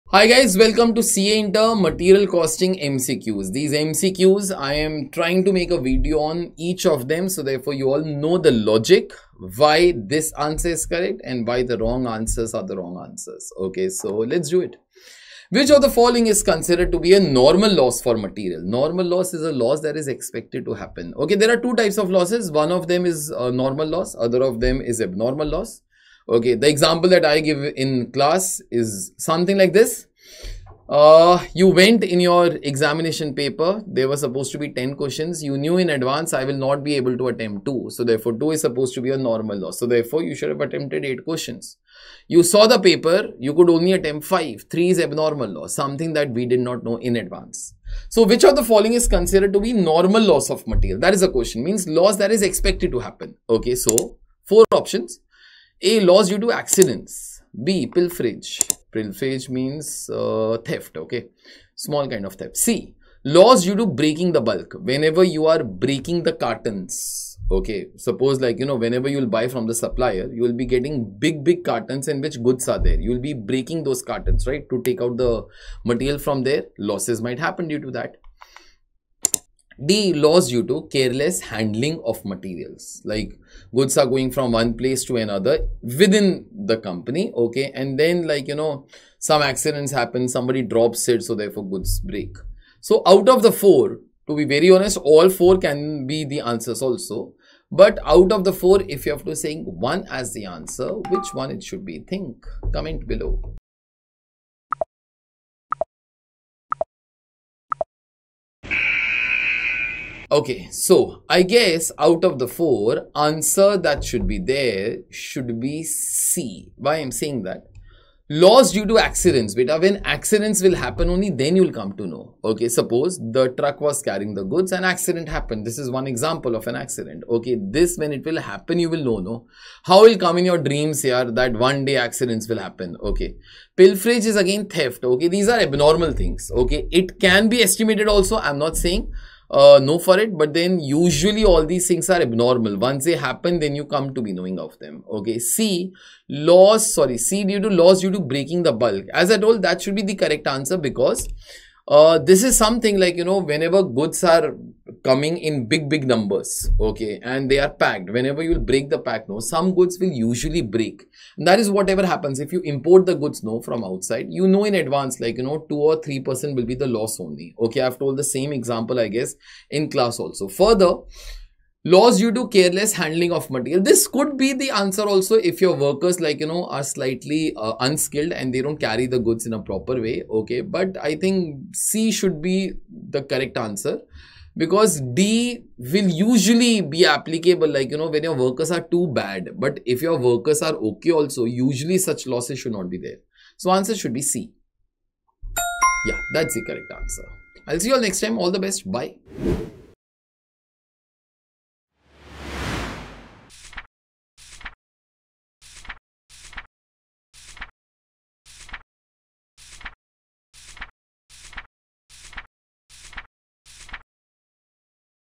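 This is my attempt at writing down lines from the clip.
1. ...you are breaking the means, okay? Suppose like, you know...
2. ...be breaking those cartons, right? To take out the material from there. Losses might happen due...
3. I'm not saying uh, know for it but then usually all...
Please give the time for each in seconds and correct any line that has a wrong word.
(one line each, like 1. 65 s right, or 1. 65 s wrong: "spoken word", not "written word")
1. 65 s wrong: "cartons", not "means"
2. 73 s right
3. 138 s right.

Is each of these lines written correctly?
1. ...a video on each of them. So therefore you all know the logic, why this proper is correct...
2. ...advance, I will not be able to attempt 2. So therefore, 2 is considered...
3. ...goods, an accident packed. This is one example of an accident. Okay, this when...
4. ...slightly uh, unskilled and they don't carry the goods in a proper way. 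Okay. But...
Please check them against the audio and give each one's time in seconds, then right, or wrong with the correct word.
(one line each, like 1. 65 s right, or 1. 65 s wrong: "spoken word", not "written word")
1. 5 s wrong: "answer", not "proper"
2. 35 s wrong: "supposed", not "considered"
3. 124 s wrong: "happened", not "packed"
4. 176 s right.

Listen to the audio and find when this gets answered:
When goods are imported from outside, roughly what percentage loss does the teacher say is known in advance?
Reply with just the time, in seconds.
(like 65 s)
165 s.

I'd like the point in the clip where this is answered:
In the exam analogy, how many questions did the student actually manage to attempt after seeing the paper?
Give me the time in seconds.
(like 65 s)
43 s.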